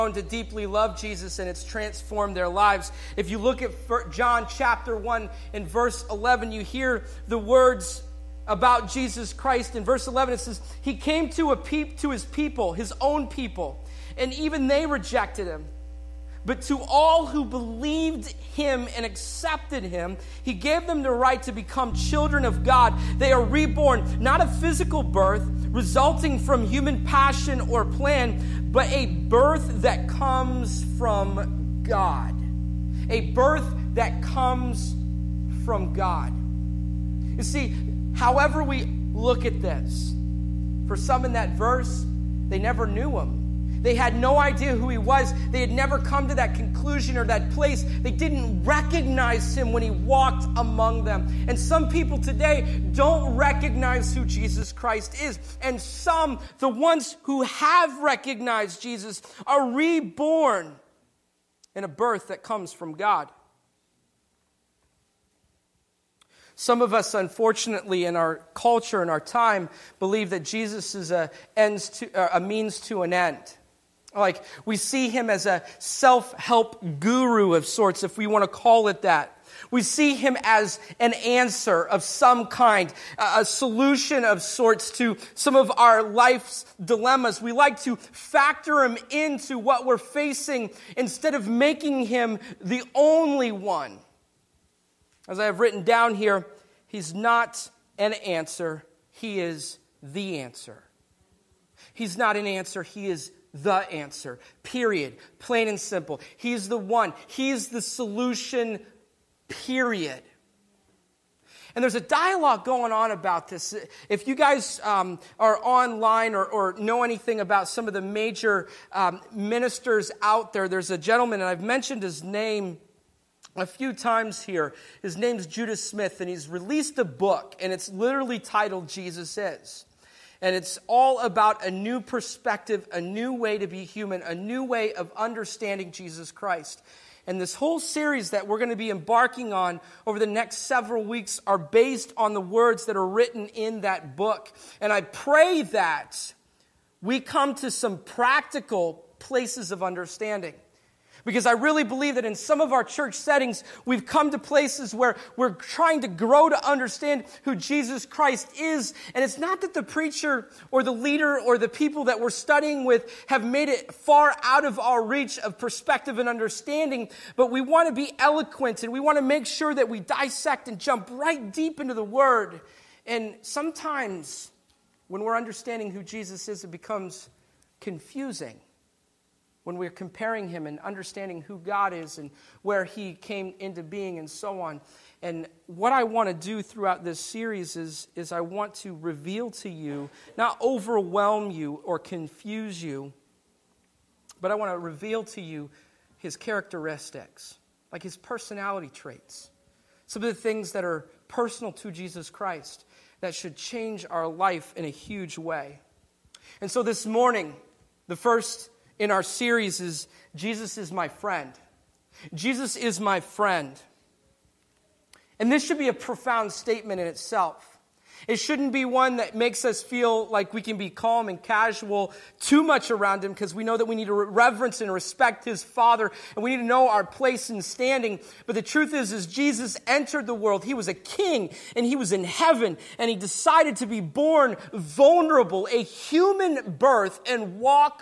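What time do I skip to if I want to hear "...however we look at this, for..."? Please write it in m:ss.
0:38.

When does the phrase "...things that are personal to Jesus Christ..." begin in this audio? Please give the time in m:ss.
3:20.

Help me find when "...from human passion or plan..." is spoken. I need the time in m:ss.
0:26.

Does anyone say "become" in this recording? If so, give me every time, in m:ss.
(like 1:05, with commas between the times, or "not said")
0:21, 2:56.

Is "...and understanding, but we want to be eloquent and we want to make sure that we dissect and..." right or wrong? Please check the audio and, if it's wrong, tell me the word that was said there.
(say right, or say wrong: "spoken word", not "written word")
right.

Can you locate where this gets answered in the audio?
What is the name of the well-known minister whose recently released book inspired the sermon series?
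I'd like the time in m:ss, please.
2:05.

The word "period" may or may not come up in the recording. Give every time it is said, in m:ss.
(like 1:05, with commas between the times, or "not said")
1:44, 1:49.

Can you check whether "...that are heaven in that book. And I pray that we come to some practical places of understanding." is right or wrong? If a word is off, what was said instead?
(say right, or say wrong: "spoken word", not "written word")
wrong: "written", not "heaven".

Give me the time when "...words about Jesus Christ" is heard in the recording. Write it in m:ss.
0:07.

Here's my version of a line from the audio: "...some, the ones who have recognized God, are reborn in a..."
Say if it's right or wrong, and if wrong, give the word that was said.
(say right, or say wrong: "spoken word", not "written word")
wrong: "Jesus", not "God".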